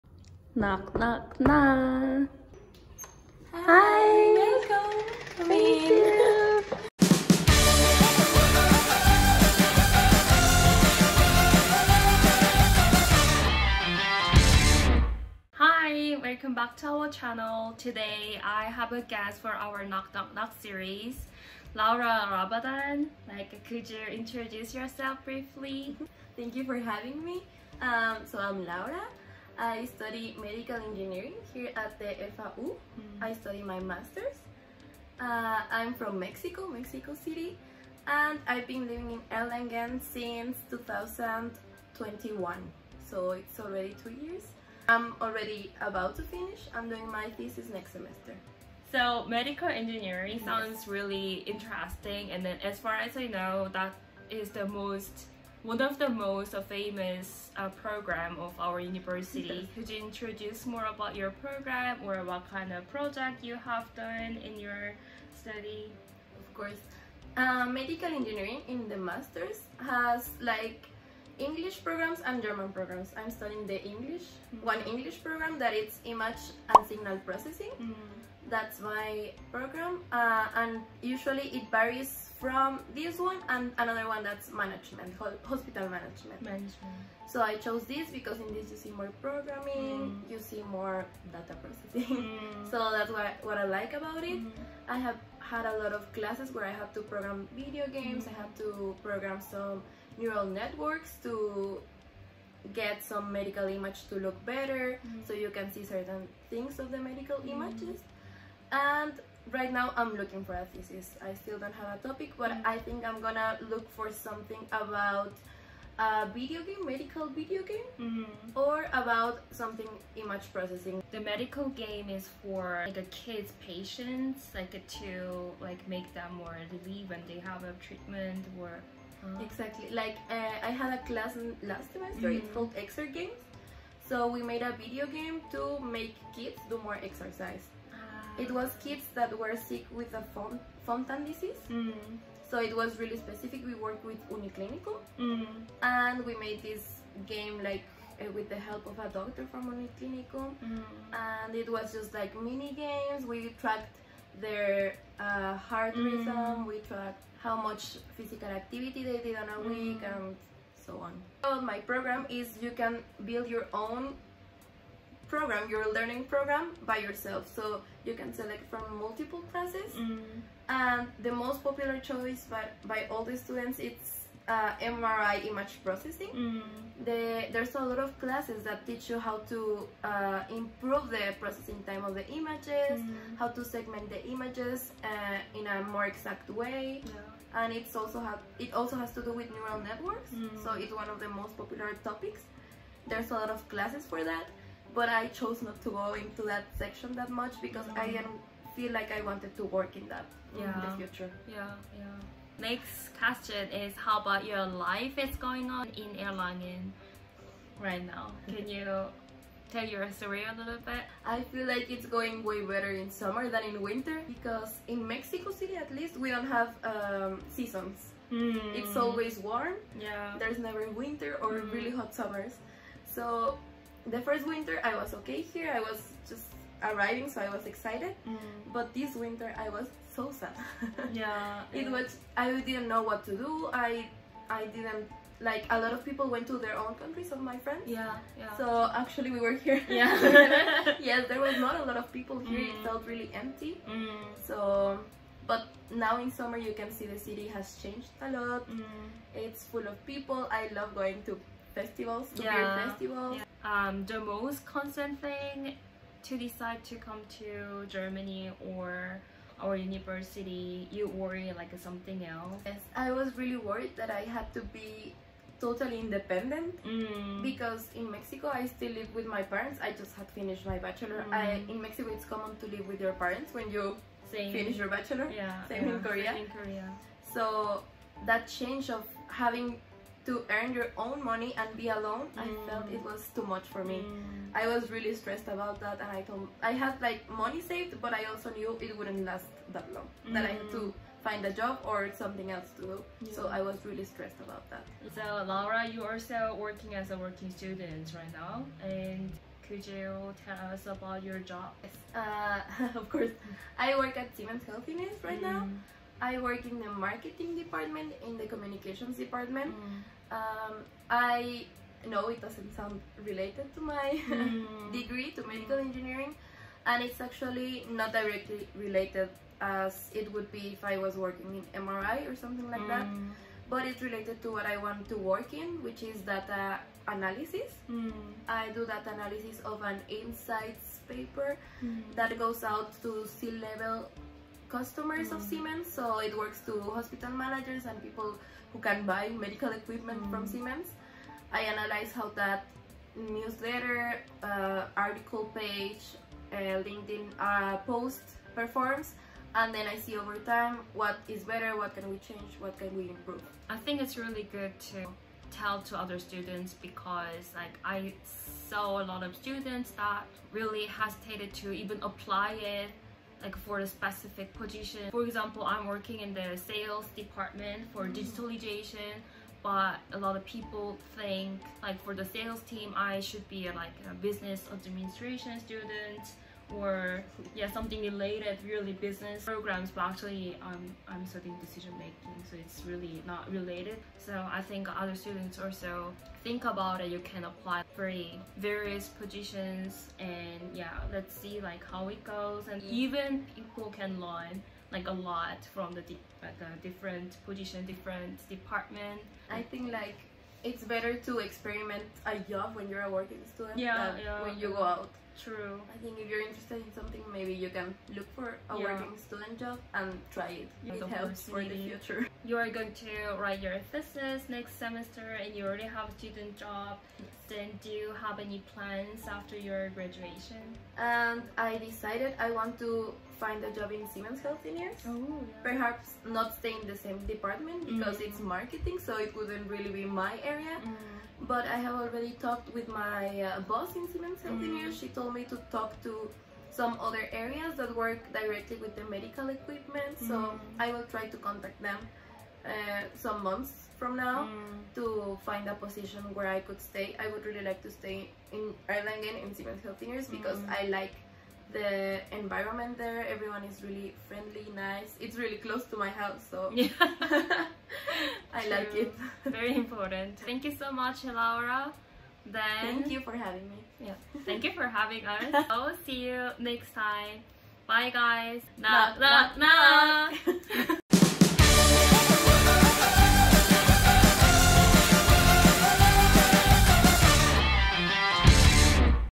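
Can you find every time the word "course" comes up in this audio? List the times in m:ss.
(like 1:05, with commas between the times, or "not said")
1:06, 5:03.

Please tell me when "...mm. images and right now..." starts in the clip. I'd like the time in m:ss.
1:47.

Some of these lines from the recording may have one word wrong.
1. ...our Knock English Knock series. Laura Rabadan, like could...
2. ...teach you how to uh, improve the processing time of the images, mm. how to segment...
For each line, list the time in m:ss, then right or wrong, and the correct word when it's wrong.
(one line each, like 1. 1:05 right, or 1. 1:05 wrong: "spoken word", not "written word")
1. 0:19 wrong: "Knock", not "English"
2. 2:58 right.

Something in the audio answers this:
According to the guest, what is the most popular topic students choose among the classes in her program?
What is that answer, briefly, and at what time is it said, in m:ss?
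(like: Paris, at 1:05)
MRI image processing, at 2:54.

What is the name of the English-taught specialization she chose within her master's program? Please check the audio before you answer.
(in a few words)
Image and signal processing.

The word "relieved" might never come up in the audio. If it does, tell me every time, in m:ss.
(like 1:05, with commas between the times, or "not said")
2:06.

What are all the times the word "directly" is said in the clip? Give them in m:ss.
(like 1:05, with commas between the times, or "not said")
5:18, 7:18.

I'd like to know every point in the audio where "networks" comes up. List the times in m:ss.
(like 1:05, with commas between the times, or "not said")
1:40, 3:09.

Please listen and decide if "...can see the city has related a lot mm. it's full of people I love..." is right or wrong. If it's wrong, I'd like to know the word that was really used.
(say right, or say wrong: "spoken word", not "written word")
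wrong: "changed", not "related".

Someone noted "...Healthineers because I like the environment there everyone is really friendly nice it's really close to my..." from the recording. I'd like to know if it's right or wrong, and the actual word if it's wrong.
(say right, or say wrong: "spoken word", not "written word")
right.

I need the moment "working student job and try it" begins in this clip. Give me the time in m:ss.
6:48.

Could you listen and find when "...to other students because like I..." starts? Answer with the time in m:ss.
5:55.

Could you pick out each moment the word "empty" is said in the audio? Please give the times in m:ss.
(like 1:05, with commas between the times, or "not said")
4:03.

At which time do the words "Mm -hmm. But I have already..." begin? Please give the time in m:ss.
7:10.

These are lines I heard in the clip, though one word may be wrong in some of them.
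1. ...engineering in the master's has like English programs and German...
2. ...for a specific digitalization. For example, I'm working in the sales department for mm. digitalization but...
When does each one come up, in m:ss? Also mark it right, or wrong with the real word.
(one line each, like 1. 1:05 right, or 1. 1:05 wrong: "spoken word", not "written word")
1. 1:08 right
2. 6:03 wrong: "position", not "digitalization".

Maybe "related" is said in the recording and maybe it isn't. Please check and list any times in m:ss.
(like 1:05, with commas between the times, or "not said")
5:13, 5:18, 5:24, 6:18, 6:23.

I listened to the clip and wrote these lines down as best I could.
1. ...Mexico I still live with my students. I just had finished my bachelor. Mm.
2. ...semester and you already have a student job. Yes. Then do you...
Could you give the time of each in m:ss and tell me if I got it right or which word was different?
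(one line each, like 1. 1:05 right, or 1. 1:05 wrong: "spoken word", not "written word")
1. 4:28 wrong: "parents", not "students"
2. 6:54 right.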